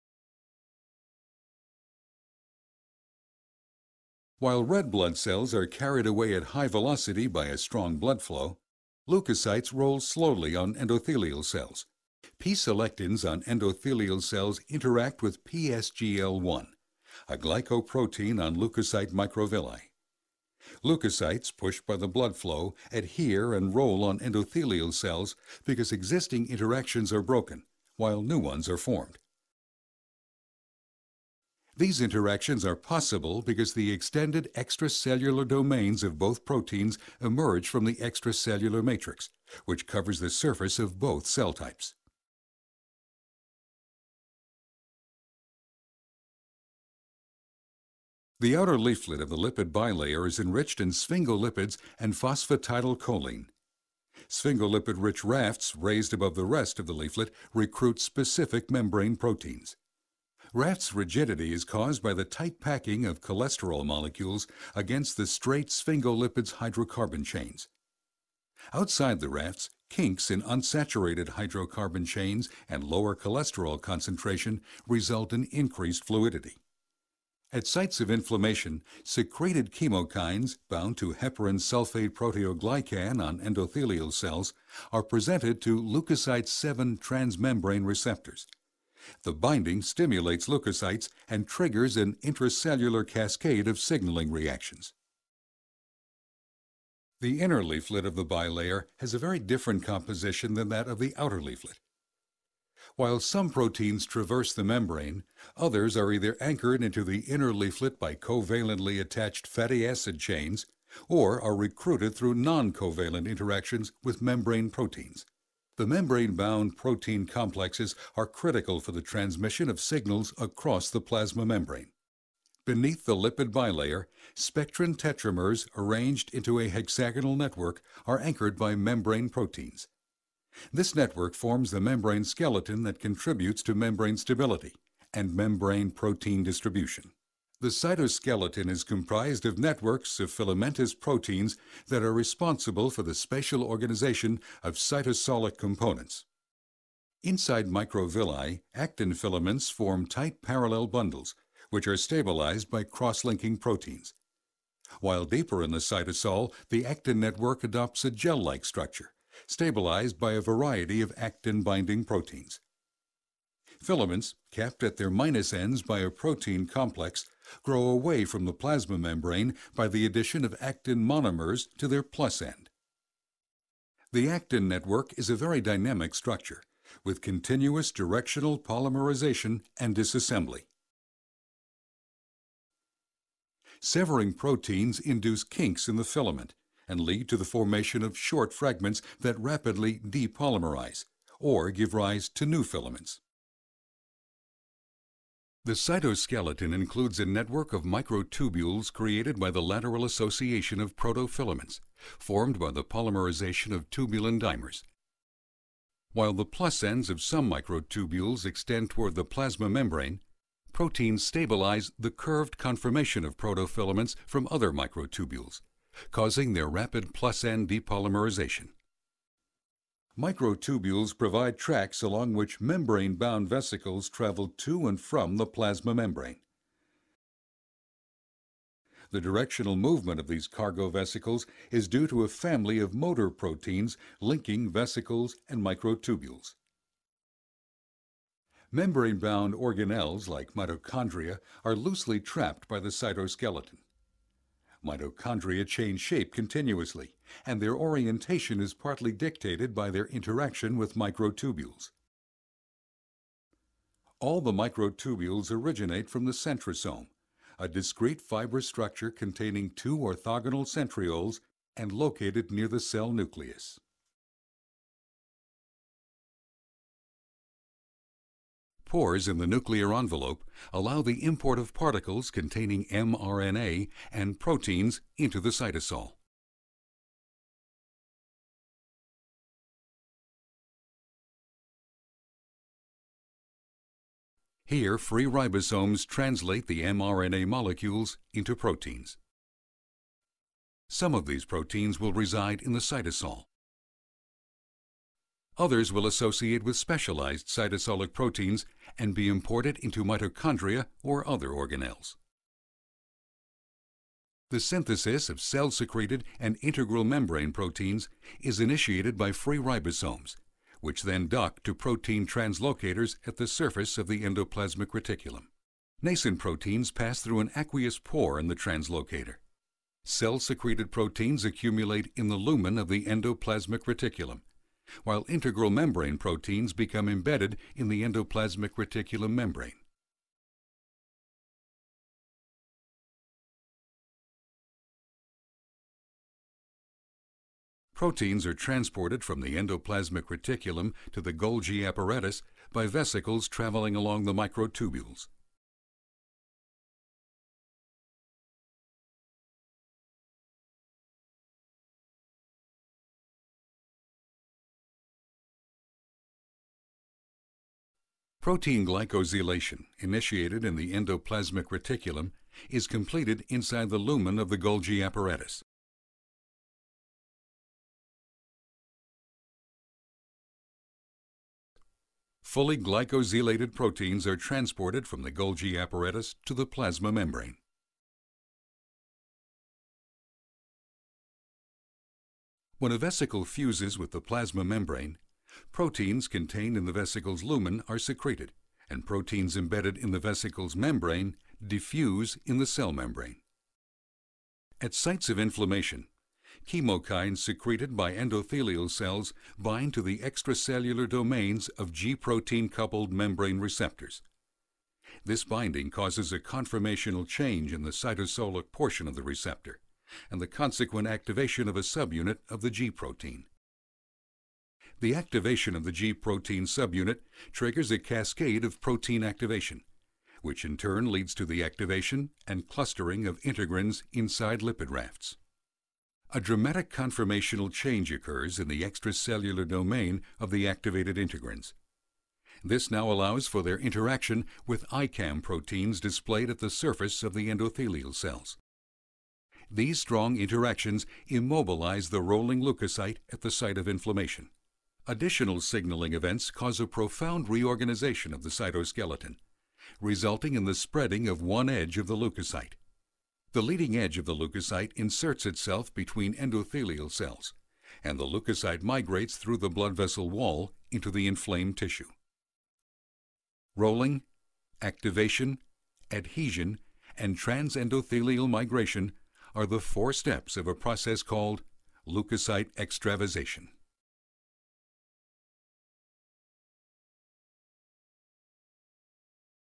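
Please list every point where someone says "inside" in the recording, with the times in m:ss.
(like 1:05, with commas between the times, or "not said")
2:27, 6:03, 7:04.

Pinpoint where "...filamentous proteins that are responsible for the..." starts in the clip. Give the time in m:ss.
2:20.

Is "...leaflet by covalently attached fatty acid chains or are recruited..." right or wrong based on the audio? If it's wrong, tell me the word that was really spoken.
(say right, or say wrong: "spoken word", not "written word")
right.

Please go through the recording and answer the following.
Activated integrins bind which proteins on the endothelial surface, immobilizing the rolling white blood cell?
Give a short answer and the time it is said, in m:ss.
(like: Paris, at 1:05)
ICAM proteins, at 7:14.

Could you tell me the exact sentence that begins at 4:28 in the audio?
Pores in the nuclear envelope allow the import of particles containing mRNA and proteins into the cytosol.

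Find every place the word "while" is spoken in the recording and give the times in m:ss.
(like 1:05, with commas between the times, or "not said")
0:04, 0:27, 1:42, 2:34, 3:26, 5:25.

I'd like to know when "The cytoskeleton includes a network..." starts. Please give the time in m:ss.
3:15.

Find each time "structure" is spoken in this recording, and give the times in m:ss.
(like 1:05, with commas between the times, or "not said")
2:38, 2:56, 4:18.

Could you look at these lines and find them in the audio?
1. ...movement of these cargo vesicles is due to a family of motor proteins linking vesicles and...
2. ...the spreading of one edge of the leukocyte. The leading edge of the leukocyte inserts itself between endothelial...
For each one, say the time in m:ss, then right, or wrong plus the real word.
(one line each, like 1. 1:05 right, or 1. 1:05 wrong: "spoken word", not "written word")
1. 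3:49 right
2. 7:30 right.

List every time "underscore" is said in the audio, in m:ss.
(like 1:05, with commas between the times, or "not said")
not said.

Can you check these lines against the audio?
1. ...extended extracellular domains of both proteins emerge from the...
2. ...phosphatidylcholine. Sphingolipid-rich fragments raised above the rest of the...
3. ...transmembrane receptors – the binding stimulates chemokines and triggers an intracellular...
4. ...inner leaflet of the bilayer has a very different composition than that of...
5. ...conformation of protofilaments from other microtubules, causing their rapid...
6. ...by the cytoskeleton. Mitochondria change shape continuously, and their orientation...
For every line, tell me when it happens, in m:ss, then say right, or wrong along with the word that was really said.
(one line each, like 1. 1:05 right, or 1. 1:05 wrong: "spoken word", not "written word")
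1. 0:33 right
2. 0:52 wrong: "rafts", not "fragments"
3. 1:26 wrong: "leukocytes", not "chemokines"
4. 1:37 right
5. 3:32 right
6. 4:02 right.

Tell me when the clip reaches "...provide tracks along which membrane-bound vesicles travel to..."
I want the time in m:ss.
3:41.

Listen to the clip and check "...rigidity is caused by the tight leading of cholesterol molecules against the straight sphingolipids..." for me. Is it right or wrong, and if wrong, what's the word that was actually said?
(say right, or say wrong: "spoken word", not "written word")
wrong: "packing", not "leading".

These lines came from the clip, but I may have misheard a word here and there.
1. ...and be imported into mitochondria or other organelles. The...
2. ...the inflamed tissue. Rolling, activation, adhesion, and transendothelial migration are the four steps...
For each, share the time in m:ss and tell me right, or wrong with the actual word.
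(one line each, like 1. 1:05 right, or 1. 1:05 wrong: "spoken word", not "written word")
1. 4:58 right
2. 7:41 right.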